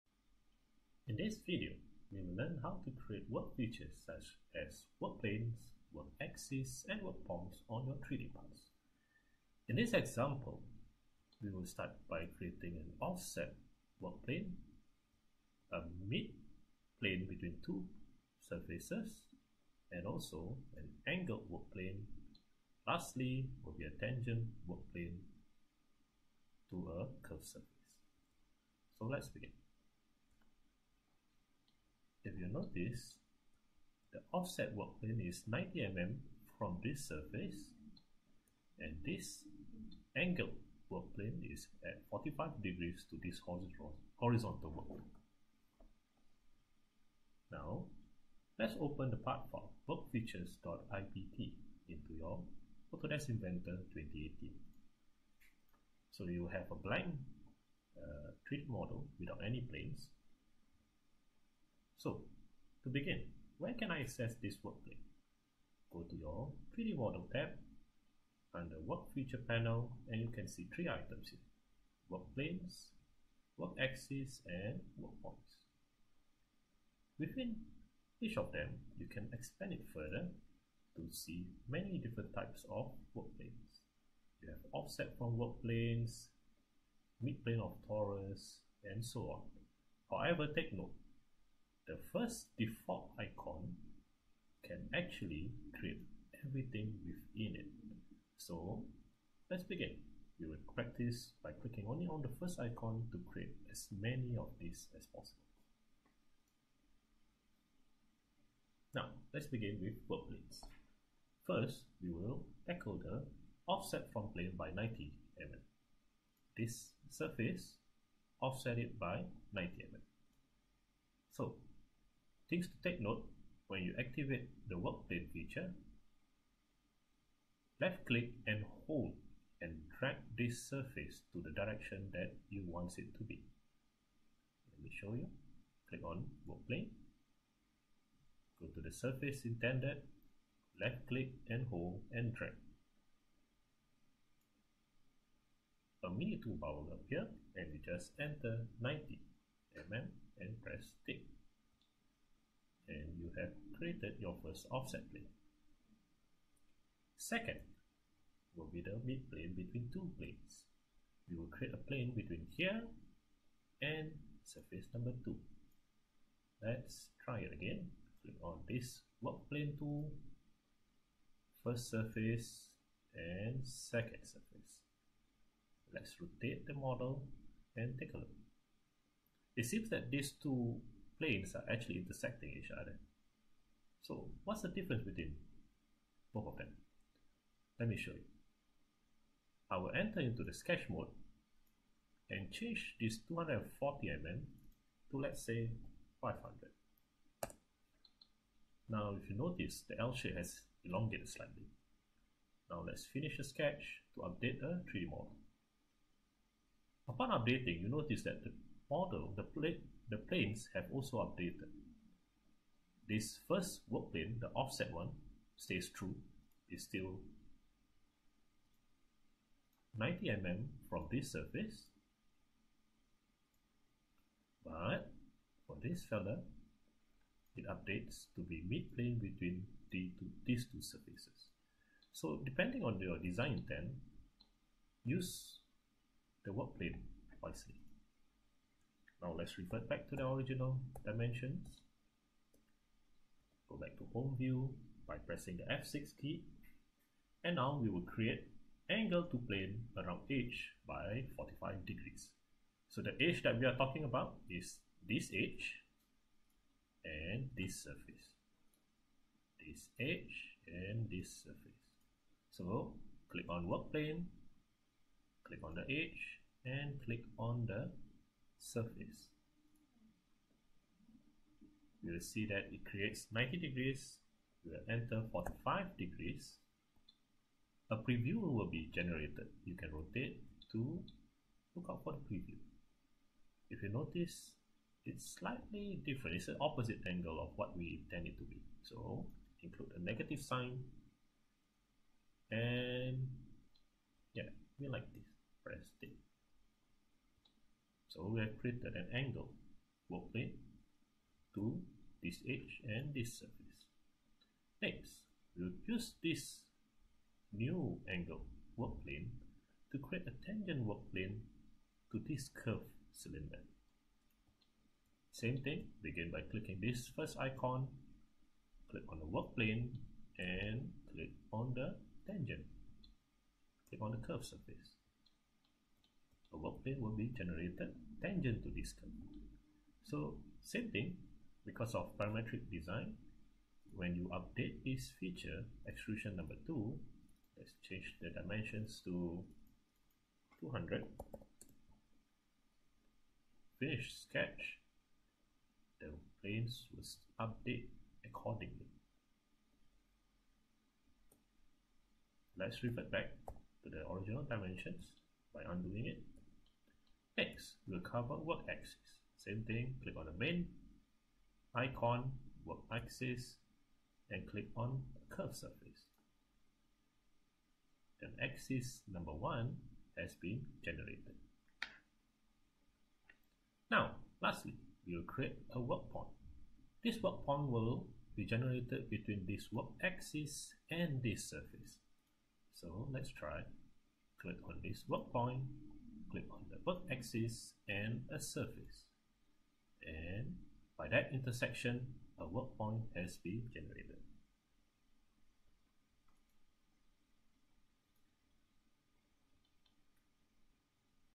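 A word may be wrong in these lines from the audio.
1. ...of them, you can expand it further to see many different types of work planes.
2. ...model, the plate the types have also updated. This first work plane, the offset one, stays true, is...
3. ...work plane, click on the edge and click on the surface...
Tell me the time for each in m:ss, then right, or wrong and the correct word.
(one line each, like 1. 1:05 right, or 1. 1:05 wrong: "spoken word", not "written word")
1. 1:18 right
2. 3:28 wrong: "planes", not "types"
3. 4:23 right.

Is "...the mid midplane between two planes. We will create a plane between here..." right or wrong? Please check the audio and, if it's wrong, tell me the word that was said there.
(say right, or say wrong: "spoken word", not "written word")
wrong: "plane", not "midplane".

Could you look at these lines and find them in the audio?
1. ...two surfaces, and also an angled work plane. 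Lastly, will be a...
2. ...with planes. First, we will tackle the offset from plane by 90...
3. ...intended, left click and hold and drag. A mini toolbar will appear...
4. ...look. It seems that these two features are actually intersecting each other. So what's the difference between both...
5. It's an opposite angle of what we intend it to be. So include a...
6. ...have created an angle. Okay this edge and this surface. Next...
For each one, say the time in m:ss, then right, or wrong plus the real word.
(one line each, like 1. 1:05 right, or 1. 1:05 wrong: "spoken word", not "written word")
1. 0:17 right
2. 1:49 right
3. 2:19 right
4. 2:58 wrong: "planes", not "features"
5. 4:46 right
6. 4:58 right.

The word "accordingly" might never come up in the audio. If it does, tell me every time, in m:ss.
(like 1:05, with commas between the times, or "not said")
5:48.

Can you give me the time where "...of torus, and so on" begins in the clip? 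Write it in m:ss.
1:27.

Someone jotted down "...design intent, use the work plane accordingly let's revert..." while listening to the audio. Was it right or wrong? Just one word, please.
wrong.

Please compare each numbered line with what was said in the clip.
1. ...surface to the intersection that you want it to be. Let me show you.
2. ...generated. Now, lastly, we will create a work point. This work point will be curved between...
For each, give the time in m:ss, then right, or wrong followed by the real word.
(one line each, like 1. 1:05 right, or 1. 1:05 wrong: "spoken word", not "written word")
1. 2:10 wrong: "direction", not "intersection"
2. 6:10 wrong: "generated", not "curved".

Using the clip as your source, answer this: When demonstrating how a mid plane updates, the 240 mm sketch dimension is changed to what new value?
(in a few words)
500.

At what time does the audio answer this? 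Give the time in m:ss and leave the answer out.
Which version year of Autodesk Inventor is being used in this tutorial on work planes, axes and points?
0:53.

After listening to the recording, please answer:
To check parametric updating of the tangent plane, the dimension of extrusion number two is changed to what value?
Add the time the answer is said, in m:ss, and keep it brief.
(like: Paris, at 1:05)
200, at 5:40.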